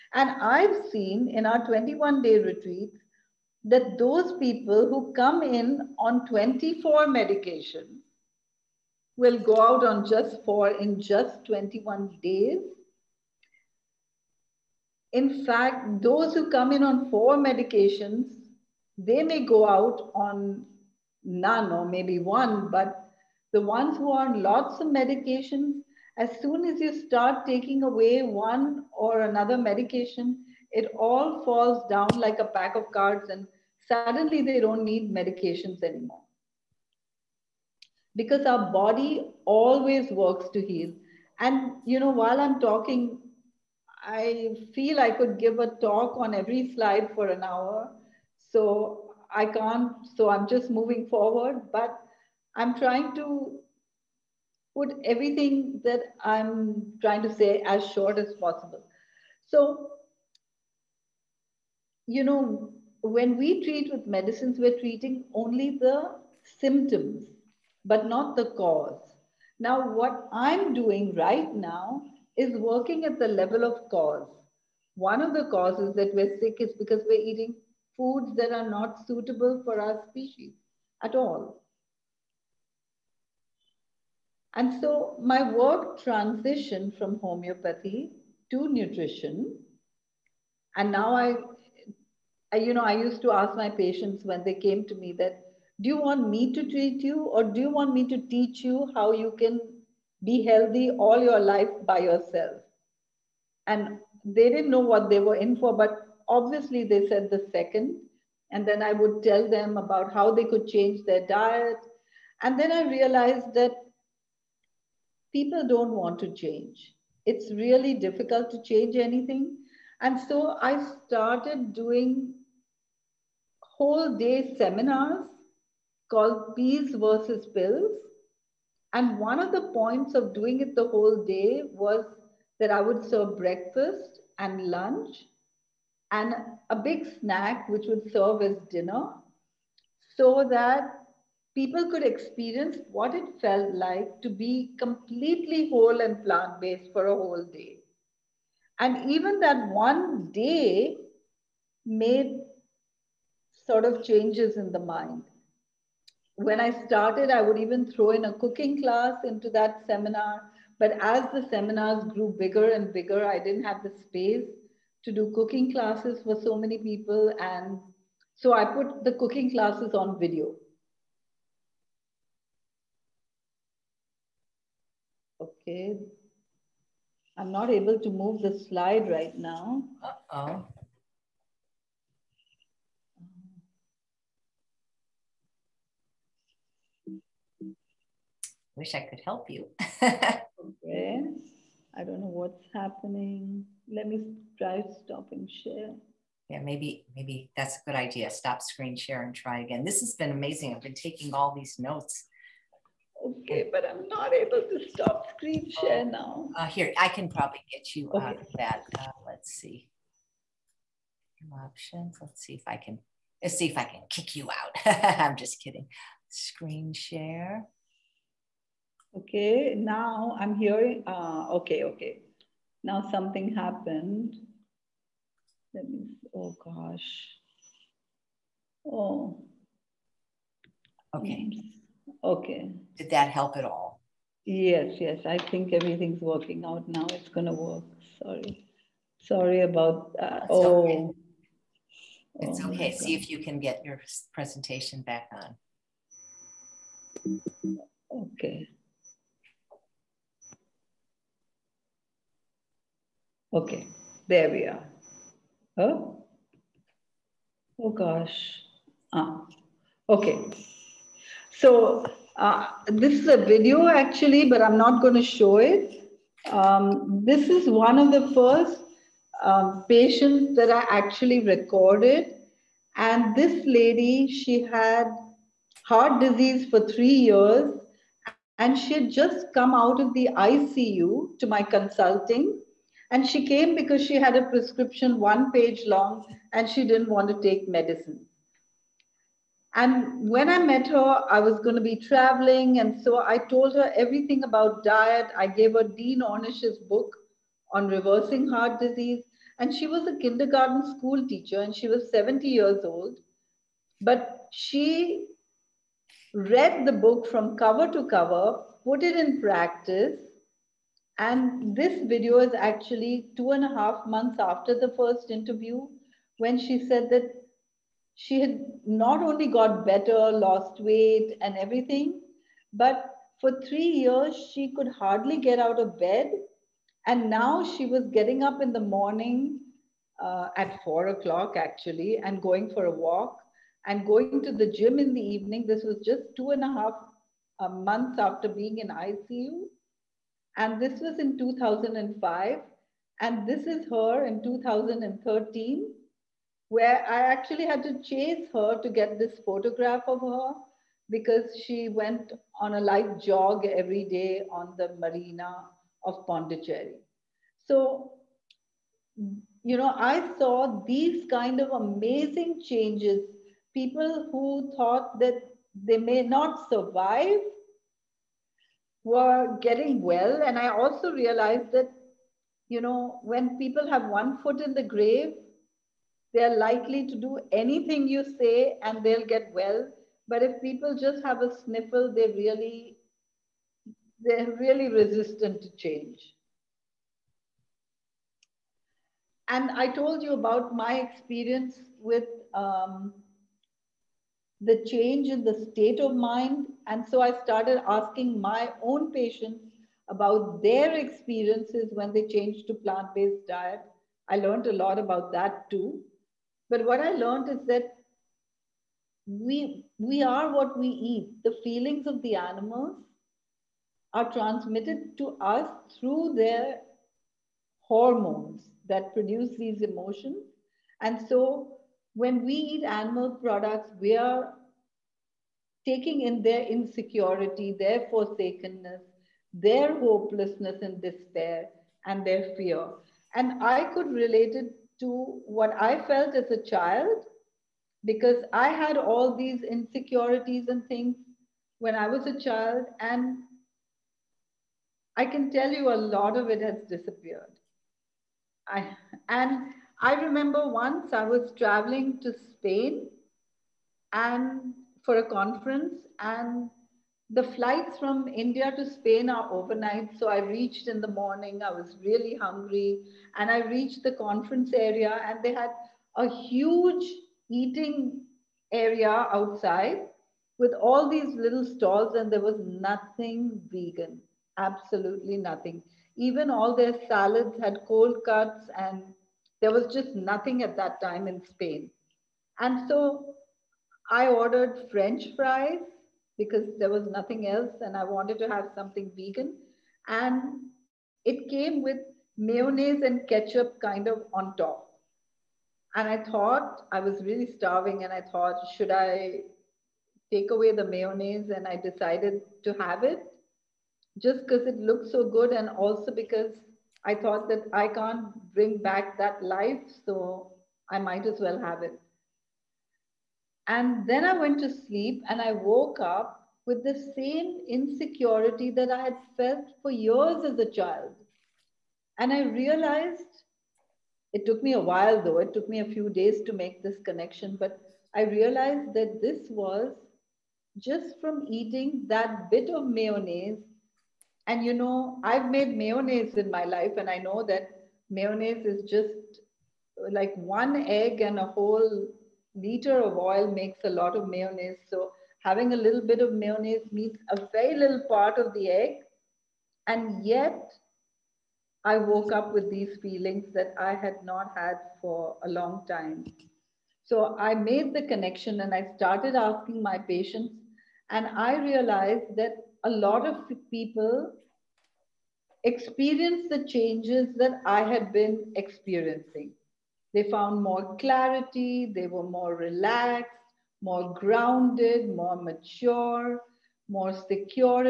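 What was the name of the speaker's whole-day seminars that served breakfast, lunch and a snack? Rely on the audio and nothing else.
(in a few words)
Peas versus Pills.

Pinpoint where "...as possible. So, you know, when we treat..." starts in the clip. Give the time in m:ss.
0:58.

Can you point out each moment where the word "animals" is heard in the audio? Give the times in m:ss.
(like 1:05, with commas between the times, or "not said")
6:52, 7:02.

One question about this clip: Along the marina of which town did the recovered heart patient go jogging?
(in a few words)
Pondicherry.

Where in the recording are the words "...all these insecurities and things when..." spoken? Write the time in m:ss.
7:18.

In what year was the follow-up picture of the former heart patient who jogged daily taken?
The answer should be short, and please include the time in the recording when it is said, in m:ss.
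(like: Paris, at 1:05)
2013, at 5:44.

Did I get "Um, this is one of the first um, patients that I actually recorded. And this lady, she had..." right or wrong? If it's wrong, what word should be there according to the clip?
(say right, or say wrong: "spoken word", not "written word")
right.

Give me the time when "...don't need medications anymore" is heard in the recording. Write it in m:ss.
0:34.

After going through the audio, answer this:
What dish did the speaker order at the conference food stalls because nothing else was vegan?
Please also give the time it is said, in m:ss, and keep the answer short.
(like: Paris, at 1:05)
French fries, at 8:04.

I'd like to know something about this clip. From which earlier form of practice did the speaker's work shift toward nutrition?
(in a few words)
Homeopathy.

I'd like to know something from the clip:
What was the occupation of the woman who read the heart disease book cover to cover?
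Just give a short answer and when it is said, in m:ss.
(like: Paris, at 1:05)
Kindergarten school teacher, at 5:00.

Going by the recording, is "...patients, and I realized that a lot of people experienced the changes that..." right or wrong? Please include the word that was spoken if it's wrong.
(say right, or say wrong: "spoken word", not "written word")
right.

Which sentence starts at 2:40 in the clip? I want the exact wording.
But as the seminars grew bigger and bigger, I didn't have the space to do cooking classes for so many people.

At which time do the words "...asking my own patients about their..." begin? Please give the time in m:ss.
6:37.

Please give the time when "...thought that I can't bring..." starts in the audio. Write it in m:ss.
8:27.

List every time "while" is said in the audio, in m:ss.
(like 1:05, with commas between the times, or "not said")
0:42, 8:44.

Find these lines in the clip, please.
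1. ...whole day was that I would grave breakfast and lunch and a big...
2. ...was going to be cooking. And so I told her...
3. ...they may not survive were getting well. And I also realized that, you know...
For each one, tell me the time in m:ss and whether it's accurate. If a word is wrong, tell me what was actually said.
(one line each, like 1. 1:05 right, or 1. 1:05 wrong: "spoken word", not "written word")
1. 2:10 wrong: "serve", not "grave"
2. 4:51 wrong: "traveling", not "cooking"
3. 6:05 right.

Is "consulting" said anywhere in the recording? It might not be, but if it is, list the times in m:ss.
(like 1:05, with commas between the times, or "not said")
4:41.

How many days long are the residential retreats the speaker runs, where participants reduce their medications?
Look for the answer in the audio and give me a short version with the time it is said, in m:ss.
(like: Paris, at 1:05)
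21, at 0:01.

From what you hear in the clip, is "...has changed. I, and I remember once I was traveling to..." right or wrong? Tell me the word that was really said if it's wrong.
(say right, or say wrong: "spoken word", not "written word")
wrong: "disappeared", not "changed".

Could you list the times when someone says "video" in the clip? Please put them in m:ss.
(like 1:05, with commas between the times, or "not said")
2:50, 4:23, 5:12.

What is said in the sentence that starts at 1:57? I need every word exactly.
It's really difficult to change anything.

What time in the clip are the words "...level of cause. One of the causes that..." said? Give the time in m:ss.
1:13.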